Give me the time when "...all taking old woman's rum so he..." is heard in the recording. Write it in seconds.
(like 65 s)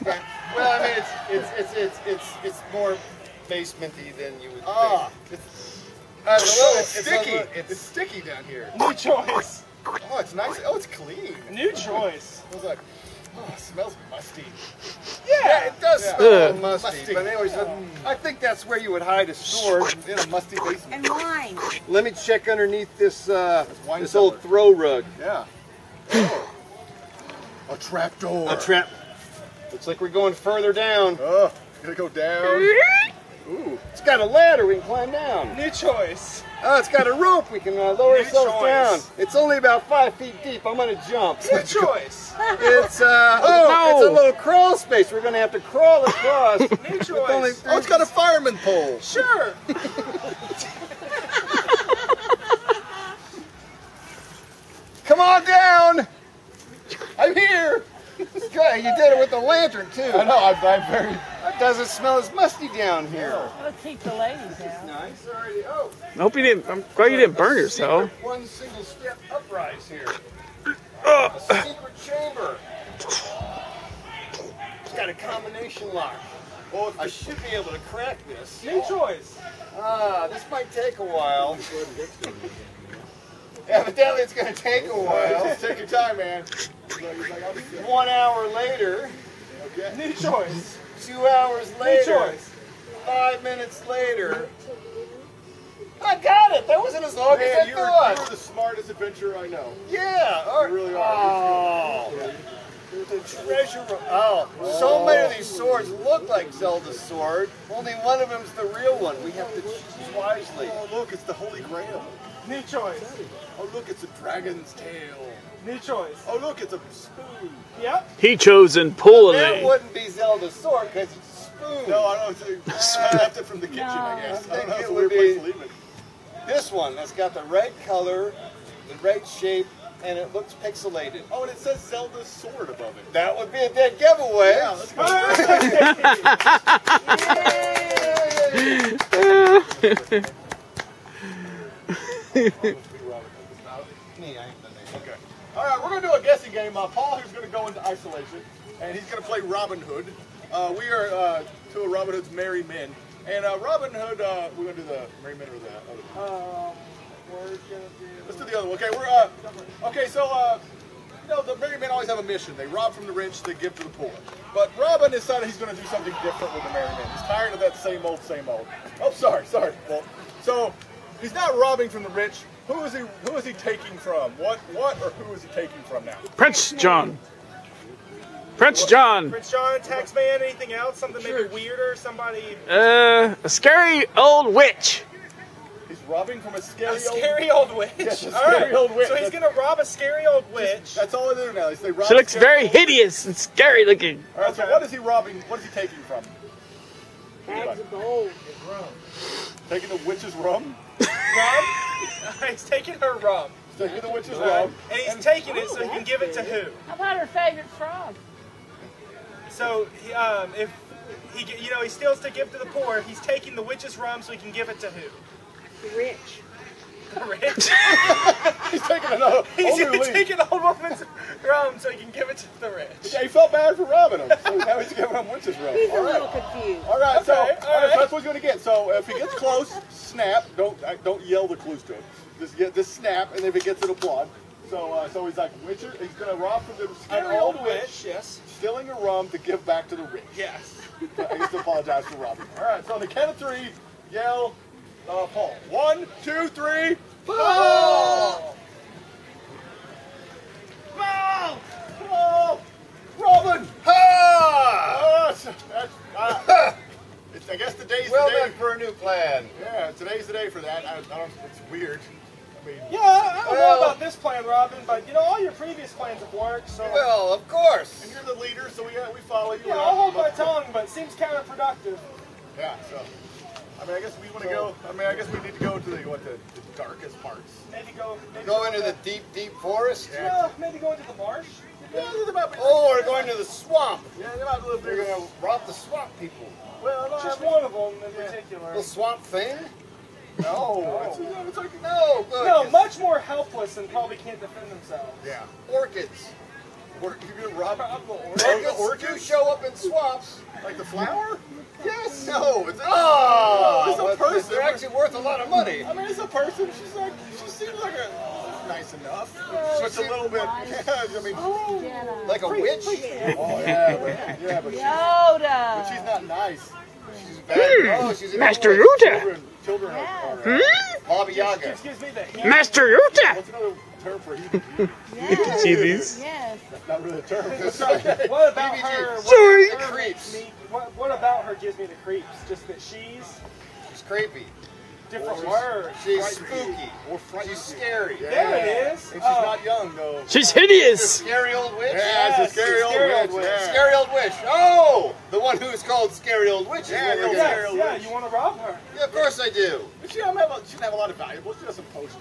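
219 s.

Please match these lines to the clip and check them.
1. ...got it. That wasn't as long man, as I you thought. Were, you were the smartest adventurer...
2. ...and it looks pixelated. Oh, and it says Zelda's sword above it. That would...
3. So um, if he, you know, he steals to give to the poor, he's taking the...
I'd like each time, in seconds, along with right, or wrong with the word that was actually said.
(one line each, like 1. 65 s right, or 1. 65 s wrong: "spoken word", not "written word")
1. 96 s right
2. 130 s right
3. 209 s right.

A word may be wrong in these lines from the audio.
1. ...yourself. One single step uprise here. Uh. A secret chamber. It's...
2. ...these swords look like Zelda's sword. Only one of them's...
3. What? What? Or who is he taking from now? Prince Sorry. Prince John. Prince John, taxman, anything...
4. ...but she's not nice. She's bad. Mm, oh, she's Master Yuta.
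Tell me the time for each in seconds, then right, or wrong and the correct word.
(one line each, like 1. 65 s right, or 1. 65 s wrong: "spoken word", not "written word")
1. 67 s right
2. 105 s right
3. 174 s wrong: "John", not "Sorry"
4. 315 s right.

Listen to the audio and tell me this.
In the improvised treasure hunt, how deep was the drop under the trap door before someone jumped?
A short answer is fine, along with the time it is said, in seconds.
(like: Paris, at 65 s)
5 feet, at 39 s.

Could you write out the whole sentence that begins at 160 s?
So uh, you know the merry men always have a mission.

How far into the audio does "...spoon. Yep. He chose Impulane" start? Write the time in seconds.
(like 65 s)
116 s.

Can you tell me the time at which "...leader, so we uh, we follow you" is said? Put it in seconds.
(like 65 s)
268 s.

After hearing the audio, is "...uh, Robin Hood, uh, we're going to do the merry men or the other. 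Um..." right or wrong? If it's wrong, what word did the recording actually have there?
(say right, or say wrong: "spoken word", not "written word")
right.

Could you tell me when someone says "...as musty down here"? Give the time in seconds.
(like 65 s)
62 s.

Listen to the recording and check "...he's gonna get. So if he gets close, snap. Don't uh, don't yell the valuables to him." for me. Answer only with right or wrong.
wrong.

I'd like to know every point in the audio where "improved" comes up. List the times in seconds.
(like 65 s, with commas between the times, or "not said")
not said.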